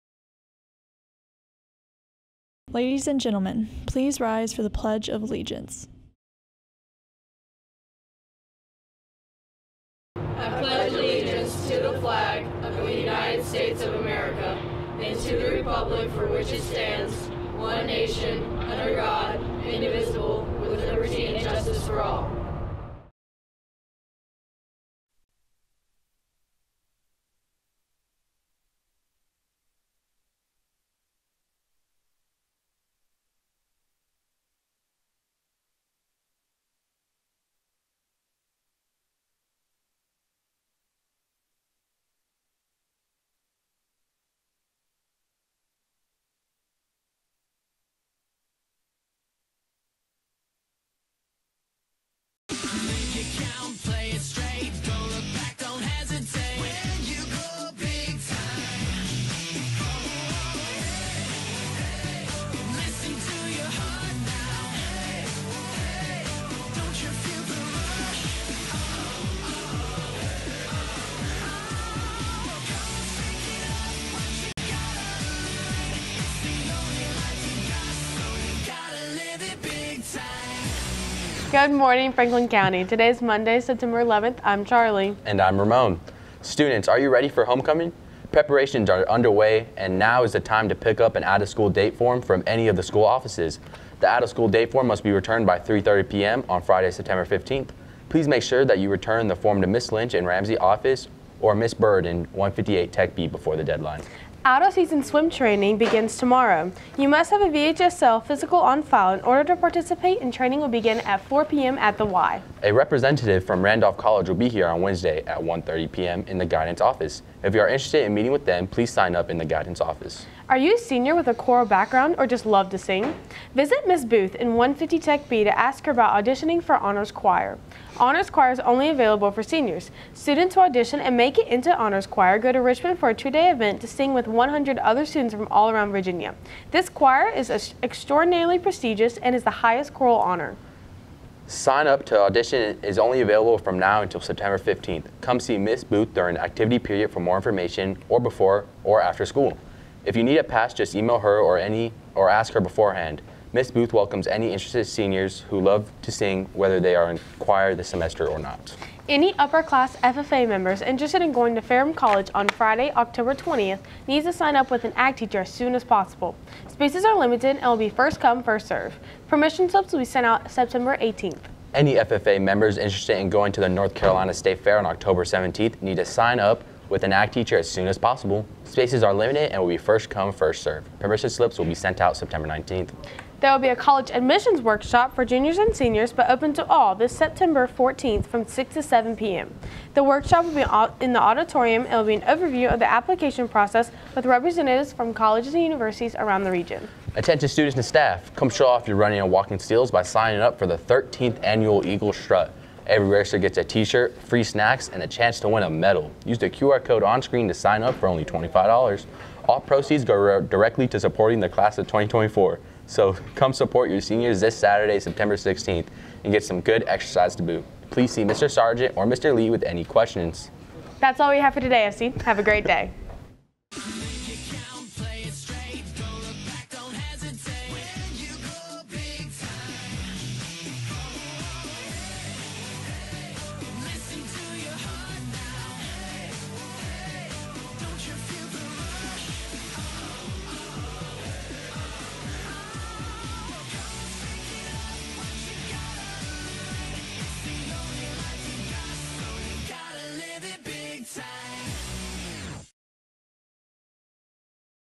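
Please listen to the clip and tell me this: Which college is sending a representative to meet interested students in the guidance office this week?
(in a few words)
Randolph College.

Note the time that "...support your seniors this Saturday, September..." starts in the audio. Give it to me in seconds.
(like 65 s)
213 s.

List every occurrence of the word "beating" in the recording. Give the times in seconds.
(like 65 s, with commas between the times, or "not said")
not said.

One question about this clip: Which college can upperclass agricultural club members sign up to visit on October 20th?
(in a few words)
Ferrum College.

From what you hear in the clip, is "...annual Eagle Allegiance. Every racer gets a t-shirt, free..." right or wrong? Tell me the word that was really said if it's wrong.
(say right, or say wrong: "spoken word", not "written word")
wrong: "Strut", not "Allegiance".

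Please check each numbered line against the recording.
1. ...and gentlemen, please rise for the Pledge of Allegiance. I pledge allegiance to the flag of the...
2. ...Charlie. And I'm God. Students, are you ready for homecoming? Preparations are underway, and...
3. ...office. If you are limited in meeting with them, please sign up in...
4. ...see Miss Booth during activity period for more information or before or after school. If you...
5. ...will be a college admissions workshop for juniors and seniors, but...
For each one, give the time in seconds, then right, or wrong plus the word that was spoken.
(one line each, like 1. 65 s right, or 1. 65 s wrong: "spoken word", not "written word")
1. 3 s right
2. 84 s wrong: "Ramon", not "God"
3. 116 s wrong: "interested", not "limited"
4. 145 s right
5. 183 s right.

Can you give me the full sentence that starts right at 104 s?
Out of season swim training begins tomorrow.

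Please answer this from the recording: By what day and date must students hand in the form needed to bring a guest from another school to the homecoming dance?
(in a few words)
Friday, September 15th.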